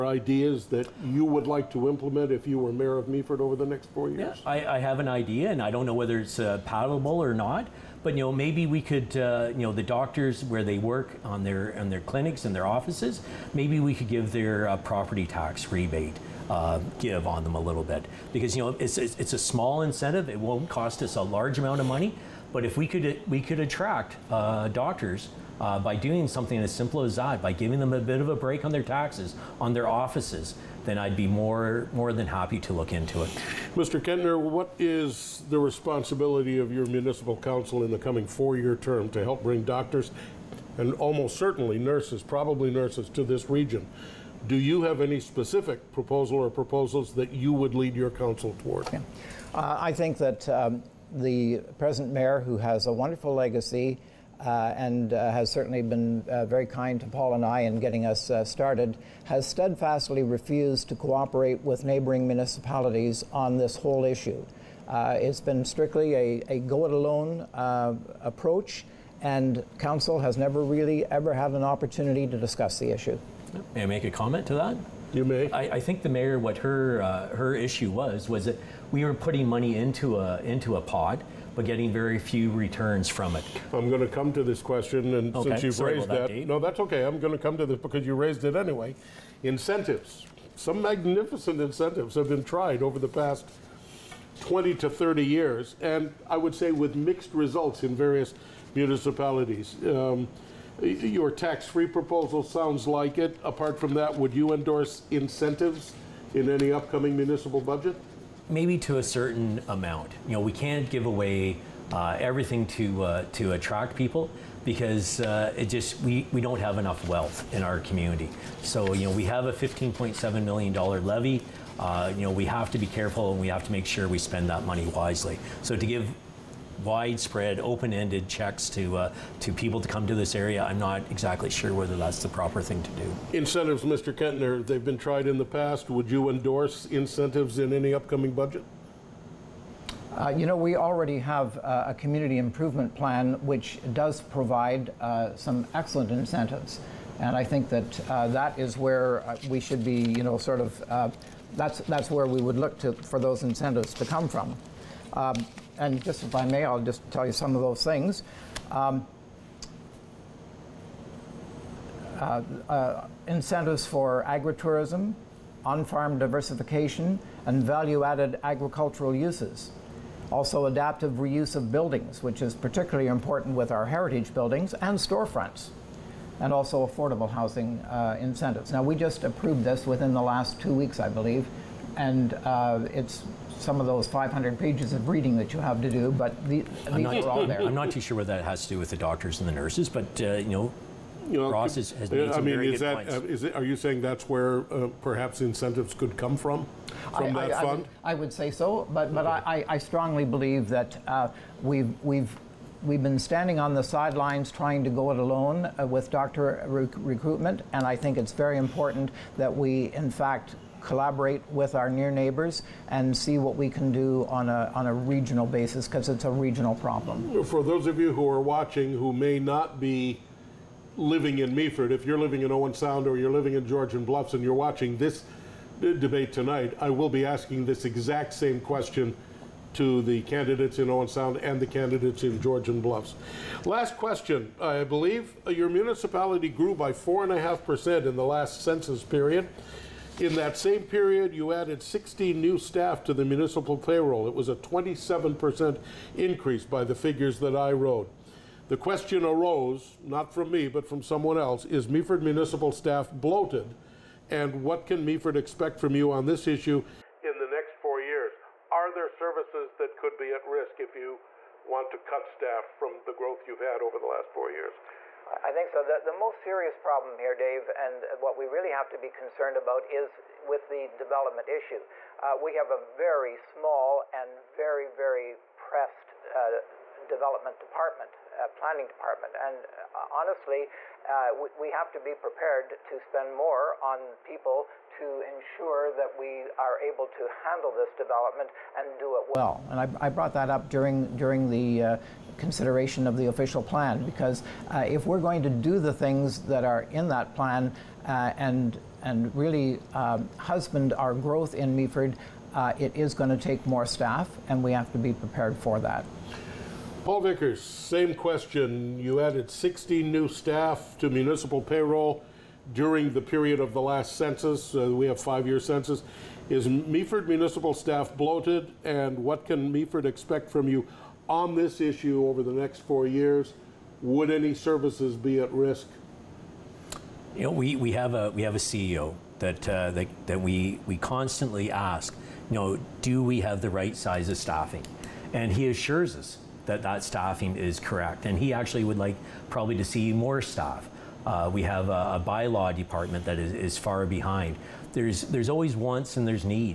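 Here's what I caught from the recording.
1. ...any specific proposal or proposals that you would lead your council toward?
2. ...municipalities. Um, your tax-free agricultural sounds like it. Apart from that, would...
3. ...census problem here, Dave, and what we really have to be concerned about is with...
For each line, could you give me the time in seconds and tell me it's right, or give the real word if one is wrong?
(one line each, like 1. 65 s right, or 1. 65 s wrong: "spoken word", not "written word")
1. 45 s right
2. 98 s wrong: "proposal", not "agricultural"
3. 266 s wrong: "serious", not "census".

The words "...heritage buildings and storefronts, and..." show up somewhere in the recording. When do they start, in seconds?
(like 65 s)
173 s.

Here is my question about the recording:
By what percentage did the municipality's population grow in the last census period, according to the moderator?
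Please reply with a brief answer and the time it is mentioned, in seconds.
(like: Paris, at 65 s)
4.5%, at 236 s.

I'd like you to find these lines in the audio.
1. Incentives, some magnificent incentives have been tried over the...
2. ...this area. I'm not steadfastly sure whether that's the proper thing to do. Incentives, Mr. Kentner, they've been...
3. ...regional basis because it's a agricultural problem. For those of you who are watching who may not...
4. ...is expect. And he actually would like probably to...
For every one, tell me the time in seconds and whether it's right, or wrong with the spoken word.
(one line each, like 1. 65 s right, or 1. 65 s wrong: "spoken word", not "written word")
1. 89 s right
2. 130 s wrong: "exactly", not "steadfastly"
3. 214 s wrong: "regional", not "agricultural"
4. 337 s wrong: "correct", not "expect".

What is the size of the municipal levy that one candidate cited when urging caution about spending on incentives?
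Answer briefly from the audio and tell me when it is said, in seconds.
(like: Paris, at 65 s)
$15.7 million, at 119 s.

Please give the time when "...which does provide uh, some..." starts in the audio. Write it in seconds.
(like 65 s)
143 s.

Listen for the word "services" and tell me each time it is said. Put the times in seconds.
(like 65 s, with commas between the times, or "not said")
259 s, 324 s.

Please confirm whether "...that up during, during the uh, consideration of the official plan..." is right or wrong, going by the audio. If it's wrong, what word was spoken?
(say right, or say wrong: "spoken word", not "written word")
right.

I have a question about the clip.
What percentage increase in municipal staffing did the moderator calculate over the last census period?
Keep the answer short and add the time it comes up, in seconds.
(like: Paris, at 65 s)
27%, at 244 s.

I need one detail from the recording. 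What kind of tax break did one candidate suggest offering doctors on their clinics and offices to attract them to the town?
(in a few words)
Property tax rebate.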